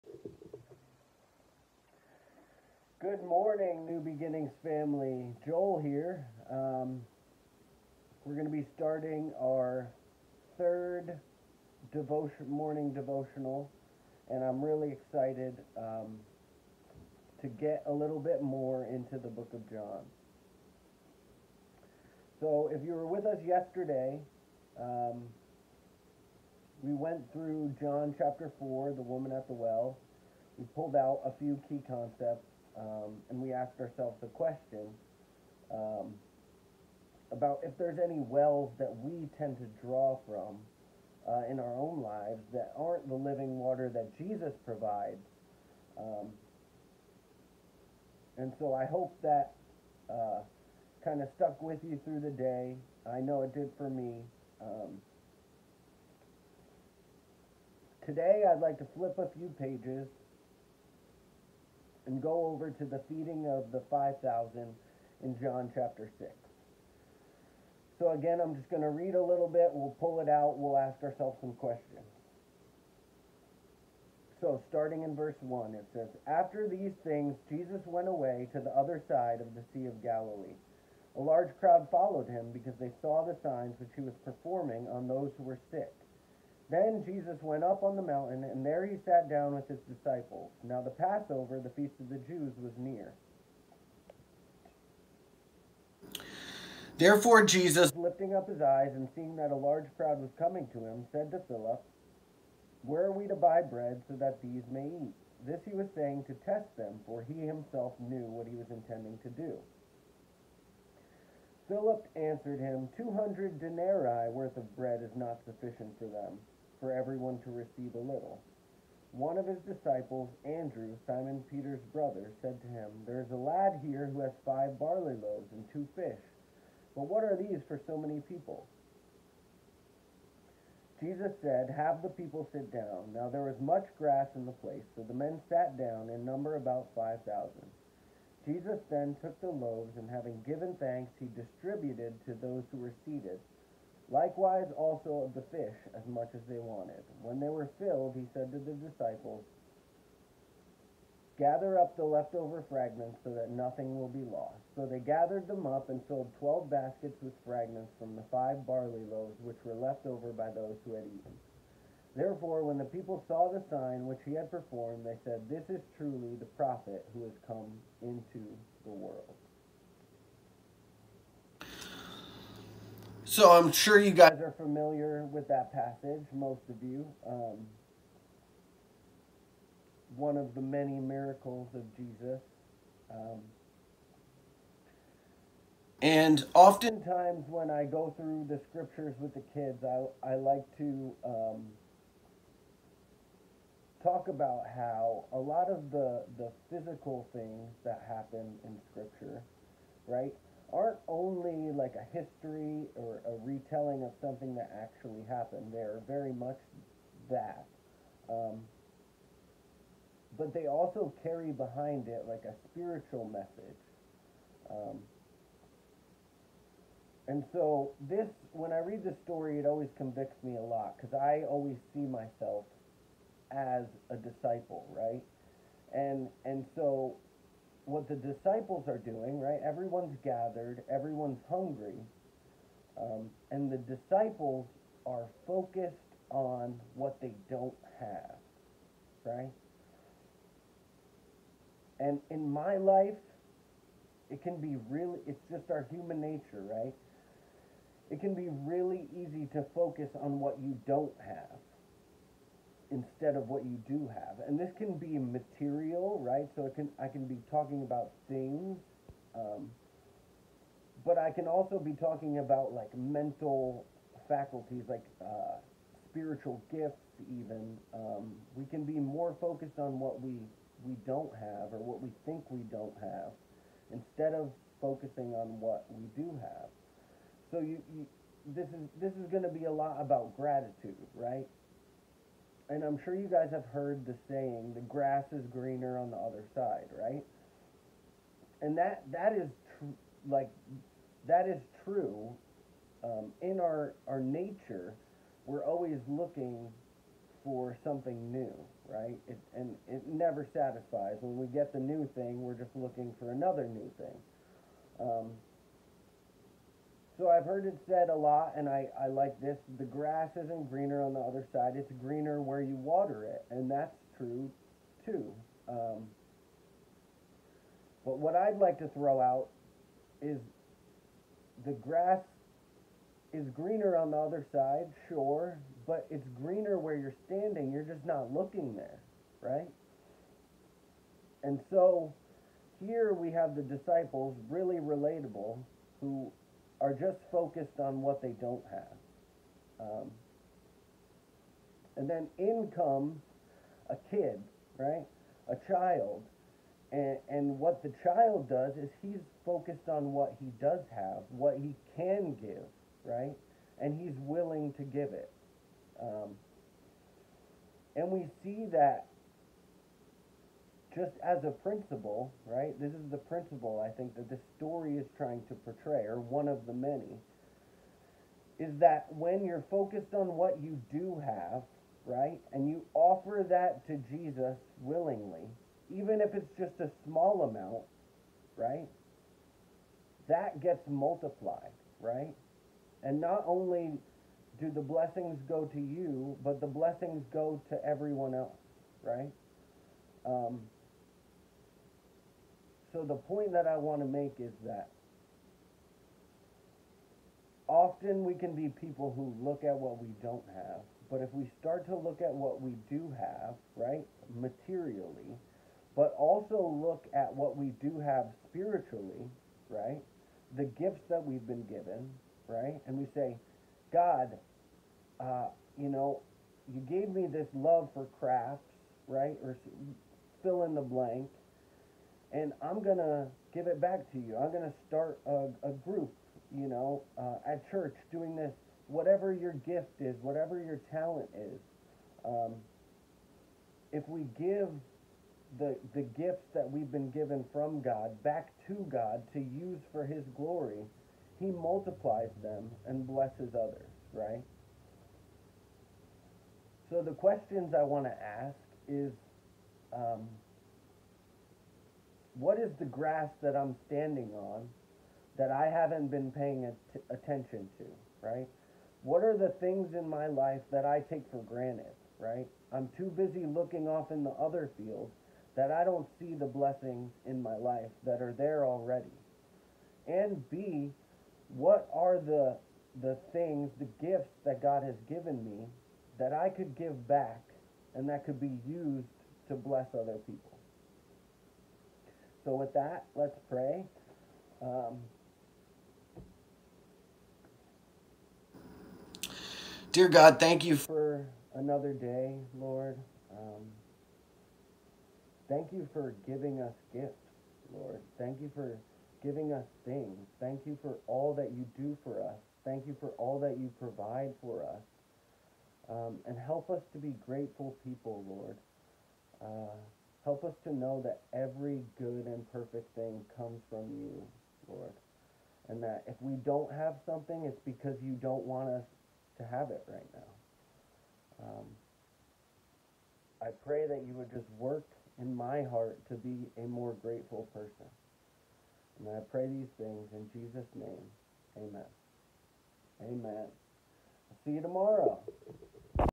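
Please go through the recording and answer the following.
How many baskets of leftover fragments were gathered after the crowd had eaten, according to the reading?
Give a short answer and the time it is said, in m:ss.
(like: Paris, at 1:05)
12, at 2:36.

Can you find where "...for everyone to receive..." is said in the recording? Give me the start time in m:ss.
1:56.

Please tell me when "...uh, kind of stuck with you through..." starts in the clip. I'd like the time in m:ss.
0:50.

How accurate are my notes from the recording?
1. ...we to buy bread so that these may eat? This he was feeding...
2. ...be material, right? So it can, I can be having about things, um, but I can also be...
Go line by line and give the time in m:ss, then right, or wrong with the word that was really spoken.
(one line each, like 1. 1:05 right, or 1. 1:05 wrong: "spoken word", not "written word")
1. 1:43 wrong: "saying", not "feeding"
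2. 4:14 wrong: "talking", not "having".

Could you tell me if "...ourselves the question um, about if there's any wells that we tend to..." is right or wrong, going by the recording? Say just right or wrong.
right.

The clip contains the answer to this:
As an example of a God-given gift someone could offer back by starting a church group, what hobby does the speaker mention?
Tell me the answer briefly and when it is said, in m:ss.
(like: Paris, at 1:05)
crafts, at 6:58.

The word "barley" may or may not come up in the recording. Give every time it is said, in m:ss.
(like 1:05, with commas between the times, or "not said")
2:04, 2:38.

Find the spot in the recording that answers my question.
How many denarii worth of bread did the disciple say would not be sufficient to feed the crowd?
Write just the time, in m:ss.
1:52.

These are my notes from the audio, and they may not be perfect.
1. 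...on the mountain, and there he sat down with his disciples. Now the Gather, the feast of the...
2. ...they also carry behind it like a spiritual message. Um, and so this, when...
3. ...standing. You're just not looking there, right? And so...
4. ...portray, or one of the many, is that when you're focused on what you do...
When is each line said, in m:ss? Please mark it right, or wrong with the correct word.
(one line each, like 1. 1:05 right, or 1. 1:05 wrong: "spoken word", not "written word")
1. 1:27 wrong: "Passover", not "Gather"
2. 3:30 right
3. 5:27 right
4. 6:05 right.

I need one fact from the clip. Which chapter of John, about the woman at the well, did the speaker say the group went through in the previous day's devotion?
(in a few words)
Chapter 4.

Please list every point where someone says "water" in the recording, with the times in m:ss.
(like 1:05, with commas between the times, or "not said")
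0:43, 5:12.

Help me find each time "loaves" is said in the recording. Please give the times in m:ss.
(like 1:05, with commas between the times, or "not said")
2:05, 2:19, 2:39.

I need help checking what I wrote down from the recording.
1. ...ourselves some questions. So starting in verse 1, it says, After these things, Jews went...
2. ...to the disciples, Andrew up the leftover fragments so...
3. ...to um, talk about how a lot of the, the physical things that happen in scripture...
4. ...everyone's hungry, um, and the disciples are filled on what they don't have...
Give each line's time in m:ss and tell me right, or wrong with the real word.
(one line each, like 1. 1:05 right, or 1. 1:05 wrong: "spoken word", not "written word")
1. 1:11 wrong: "Jesus", not "Jews"
2. 2:28 wrong: "Gather", not "Andrew"
3. 3:10 right
4. 3:50 wrong: "focused", not "filled".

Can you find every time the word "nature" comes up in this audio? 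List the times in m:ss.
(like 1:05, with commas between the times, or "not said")
4:06, 4:54.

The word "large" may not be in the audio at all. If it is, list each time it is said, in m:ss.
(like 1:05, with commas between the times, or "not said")
1:21, 1:39.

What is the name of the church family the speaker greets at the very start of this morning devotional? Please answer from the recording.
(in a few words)
New Beginnings.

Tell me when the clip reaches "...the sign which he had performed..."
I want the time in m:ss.
2:43.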